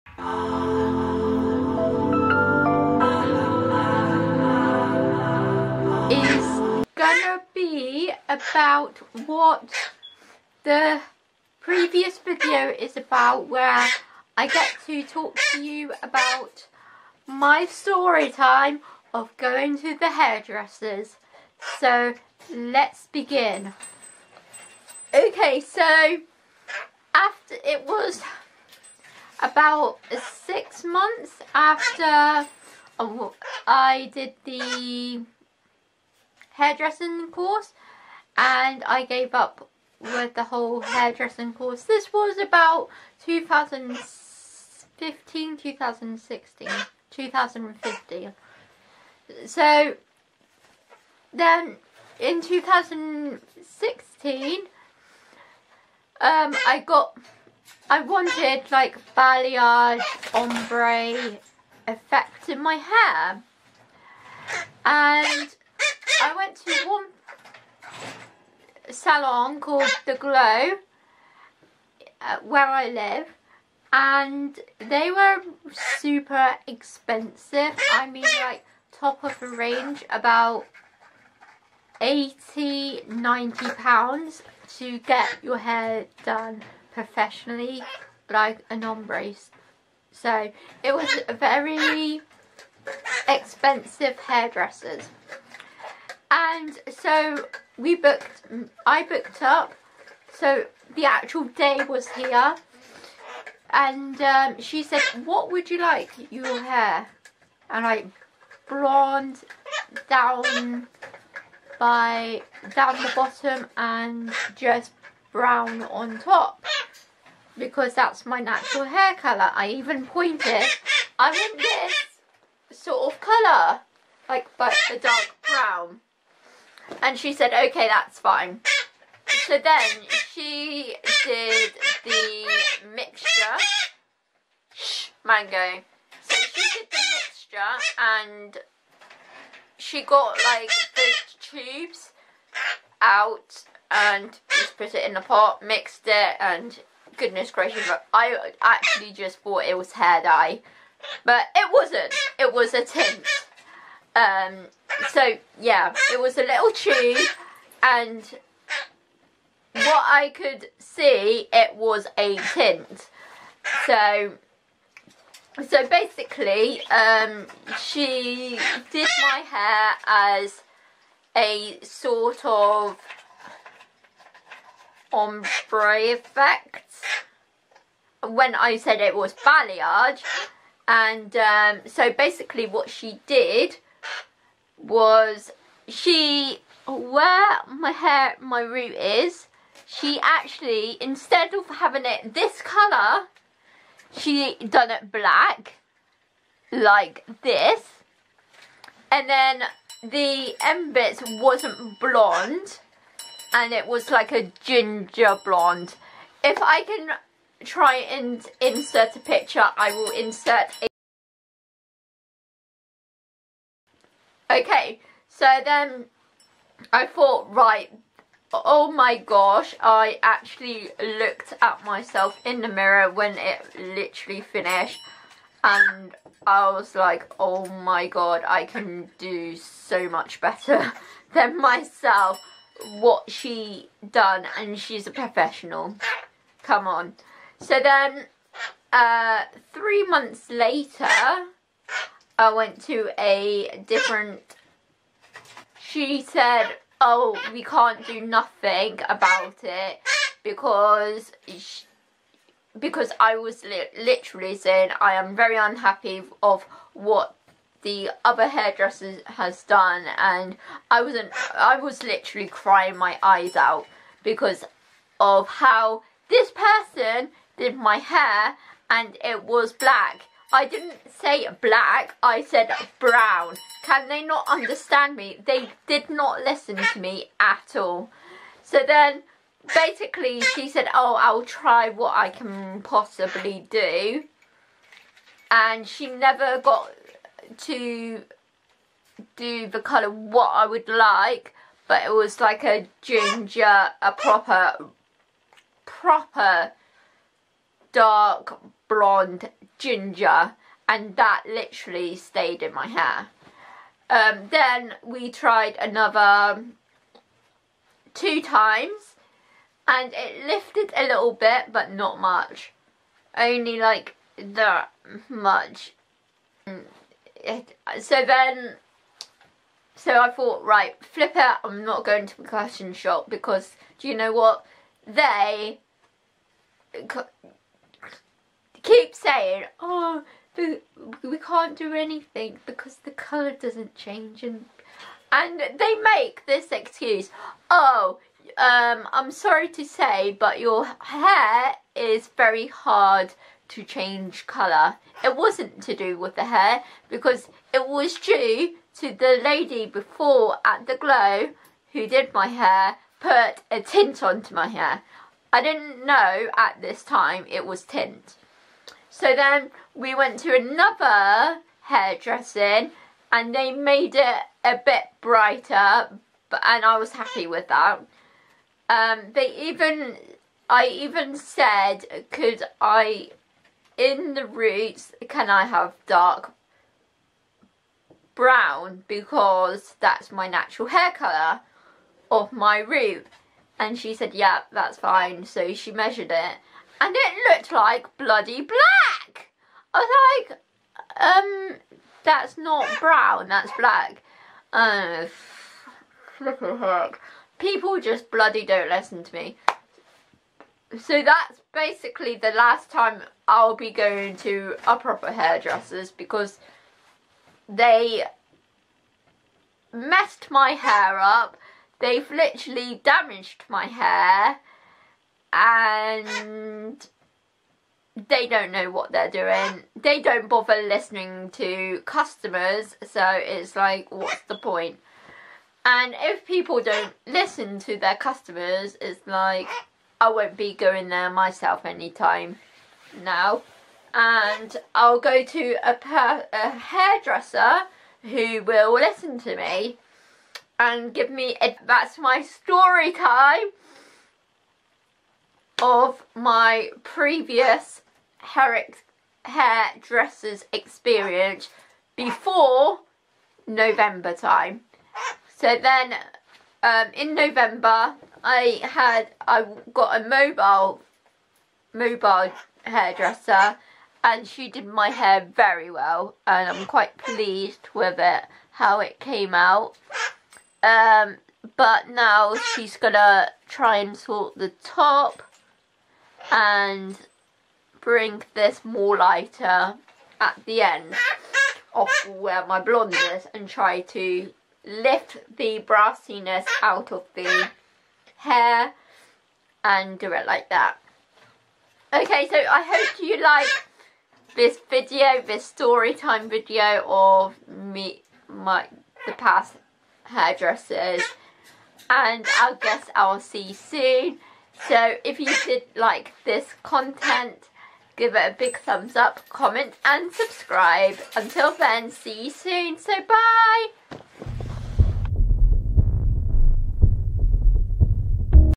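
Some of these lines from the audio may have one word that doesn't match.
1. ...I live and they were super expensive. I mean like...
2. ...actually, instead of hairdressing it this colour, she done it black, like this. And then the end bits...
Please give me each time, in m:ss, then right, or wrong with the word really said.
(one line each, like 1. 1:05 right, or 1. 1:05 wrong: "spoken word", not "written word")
1. 1:12 right
2. 3:10 wrong: "having", not "hairdressing".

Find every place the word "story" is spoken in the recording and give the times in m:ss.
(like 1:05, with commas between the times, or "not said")
0:17, 7:22, 8:15.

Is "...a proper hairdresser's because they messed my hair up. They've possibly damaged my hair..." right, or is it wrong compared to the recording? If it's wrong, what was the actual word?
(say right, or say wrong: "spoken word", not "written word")
wrong: "literally", not "possibly".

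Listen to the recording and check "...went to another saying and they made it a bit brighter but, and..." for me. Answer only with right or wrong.
wrong.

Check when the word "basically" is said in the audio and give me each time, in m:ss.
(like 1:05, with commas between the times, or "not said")
2:45, 3:02, 4:39, 6:41.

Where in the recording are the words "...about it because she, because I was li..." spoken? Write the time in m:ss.
4:09.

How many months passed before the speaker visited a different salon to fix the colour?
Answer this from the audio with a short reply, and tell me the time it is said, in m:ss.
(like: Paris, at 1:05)
3, at 3:59.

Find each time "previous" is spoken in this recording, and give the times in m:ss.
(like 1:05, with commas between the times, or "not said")
0:11, 7:27.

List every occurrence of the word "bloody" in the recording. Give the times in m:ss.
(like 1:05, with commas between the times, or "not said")
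6:28, 6:38.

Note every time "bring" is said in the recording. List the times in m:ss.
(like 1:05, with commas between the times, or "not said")
7:57.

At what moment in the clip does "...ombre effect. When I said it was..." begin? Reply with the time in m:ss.
2:55.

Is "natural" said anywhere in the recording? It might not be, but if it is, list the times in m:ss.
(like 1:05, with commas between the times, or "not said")
1:58, 6:20.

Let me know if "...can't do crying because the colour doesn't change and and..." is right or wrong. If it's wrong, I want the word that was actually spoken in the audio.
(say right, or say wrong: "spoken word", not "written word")
wrong: "anything", not "crying".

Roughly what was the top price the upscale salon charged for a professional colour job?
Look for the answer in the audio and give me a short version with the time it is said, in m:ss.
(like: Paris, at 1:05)
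£90, at 1:23.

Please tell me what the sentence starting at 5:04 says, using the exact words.
Um, then we tried another two times and it lifted a little bit but not much.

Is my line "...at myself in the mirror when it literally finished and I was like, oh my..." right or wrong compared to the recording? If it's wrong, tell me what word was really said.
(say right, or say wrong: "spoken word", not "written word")
right.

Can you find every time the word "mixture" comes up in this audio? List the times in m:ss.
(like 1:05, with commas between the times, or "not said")
2:12, 2:16.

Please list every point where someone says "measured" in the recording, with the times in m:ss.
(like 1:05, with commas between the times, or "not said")
6:25.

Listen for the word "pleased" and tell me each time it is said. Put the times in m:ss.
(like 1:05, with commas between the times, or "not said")
7:47.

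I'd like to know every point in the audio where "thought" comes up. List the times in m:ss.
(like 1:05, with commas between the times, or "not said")
2:29, 3:37, 5:20.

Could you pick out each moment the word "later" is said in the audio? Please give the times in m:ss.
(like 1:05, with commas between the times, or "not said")
4:00.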